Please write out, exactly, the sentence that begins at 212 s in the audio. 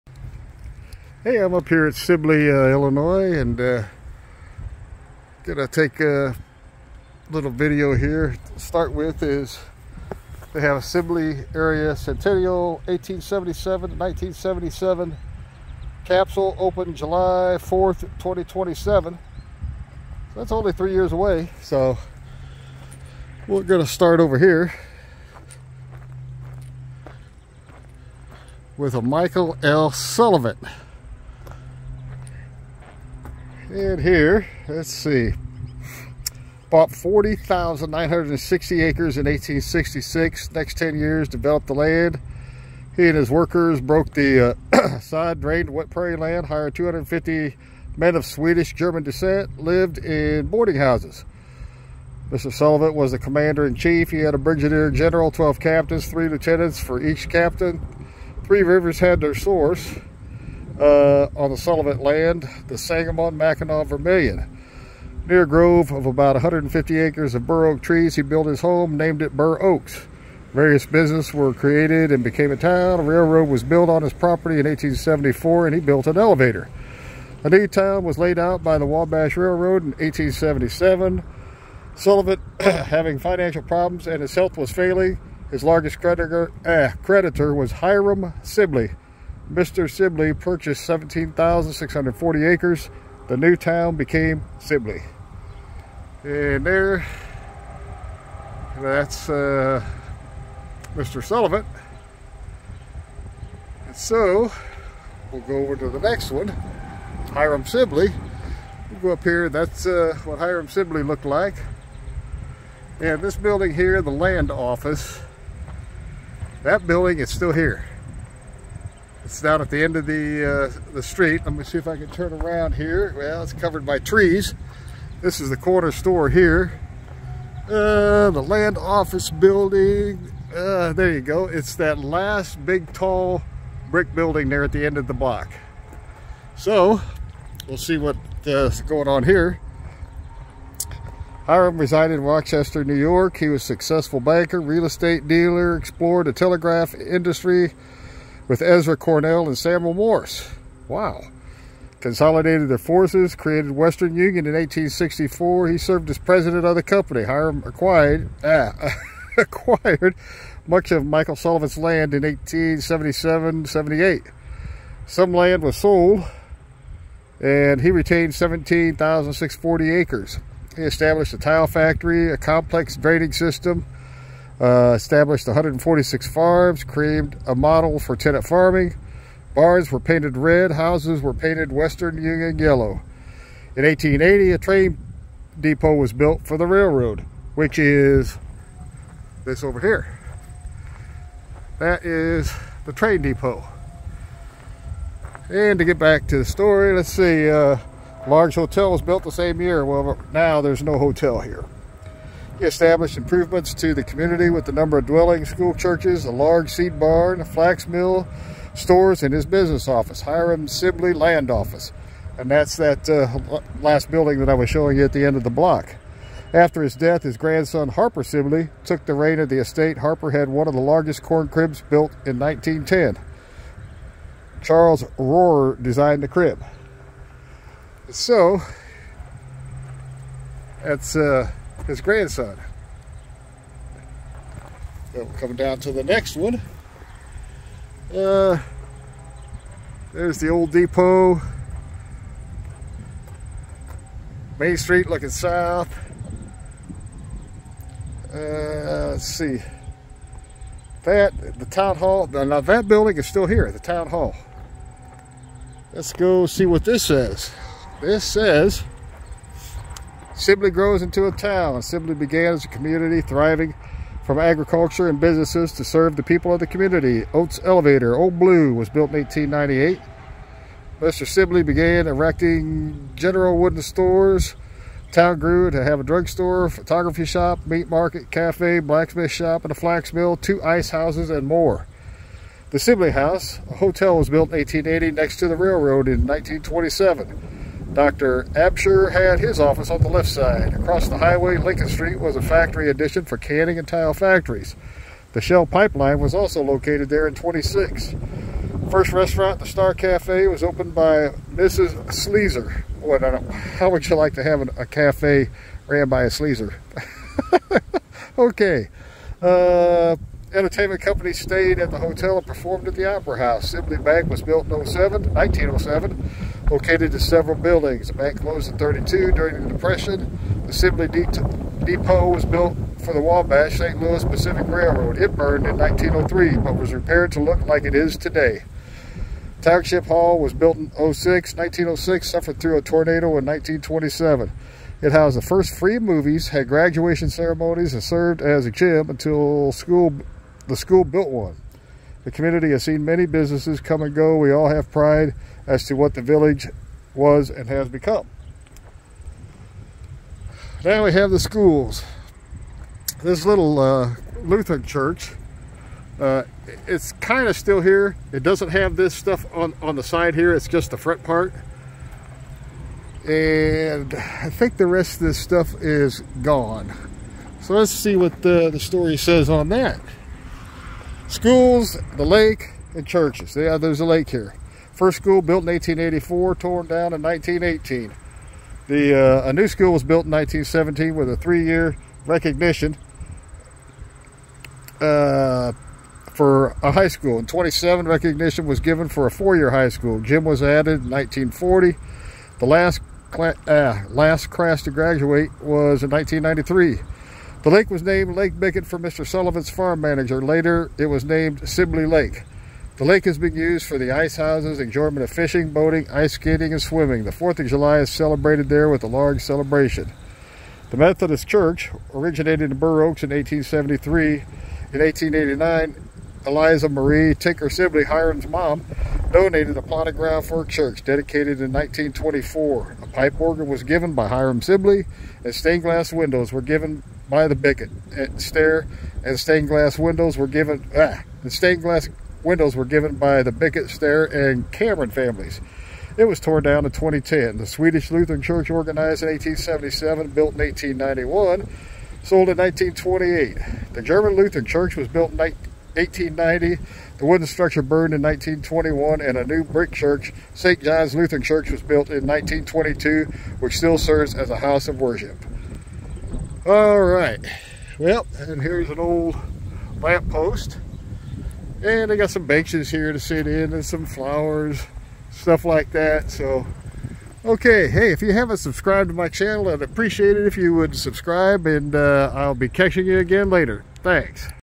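And that's that uh, last building that I was showing you at the end of the block.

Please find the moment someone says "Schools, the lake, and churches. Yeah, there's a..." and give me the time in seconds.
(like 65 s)
371 s.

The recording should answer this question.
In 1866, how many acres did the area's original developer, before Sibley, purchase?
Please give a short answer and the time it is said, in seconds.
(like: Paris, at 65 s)
40,960, at 36 s.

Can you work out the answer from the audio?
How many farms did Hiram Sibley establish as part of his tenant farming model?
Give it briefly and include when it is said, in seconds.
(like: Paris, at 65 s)
146, at 175 s.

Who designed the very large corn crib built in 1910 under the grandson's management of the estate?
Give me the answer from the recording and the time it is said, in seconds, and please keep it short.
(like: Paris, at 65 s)
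Charles Rohrer, at 224 s.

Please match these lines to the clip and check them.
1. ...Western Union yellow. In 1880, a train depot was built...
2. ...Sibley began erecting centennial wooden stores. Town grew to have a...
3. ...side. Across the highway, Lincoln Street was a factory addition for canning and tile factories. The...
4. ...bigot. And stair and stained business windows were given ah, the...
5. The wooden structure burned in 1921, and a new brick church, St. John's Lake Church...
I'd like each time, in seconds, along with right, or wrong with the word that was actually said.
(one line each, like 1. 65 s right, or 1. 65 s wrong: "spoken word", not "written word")
1. 181 s right
2. 271 s wrong: "general", not "centennial"
3. 290 s right
4. 427 s wrong: "glass", not "business"
5. 447 s wrong: "Lutheran", not "Lake".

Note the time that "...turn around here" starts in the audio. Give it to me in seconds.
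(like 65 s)
122 s.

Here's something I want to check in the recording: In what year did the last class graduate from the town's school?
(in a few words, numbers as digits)
1993.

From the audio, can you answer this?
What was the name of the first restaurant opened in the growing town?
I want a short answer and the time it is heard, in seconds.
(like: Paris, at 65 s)
Star Cafe, at 299 s.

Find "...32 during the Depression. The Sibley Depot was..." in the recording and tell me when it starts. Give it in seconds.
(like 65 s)
318 s.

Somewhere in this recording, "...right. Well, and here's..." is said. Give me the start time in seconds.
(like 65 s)
457 s.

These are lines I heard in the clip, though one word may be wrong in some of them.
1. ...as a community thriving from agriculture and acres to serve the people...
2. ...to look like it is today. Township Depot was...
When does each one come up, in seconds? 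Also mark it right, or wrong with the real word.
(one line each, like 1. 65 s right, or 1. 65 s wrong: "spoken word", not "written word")
1. 262 s wrong: "businesses", not "acres"
2. 327 s wrong: "Hall", not "Depot".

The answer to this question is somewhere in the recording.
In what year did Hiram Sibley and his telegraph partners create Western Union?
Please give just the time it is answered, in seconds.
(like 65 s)
154 s.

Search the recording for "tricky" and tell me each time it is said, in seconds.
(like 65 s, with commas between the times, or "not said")
not said.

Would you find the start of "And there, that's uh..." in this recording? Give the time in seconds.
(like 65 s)
96 s.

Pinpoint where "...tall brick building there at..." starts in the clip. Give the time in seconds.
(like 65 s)
132 s.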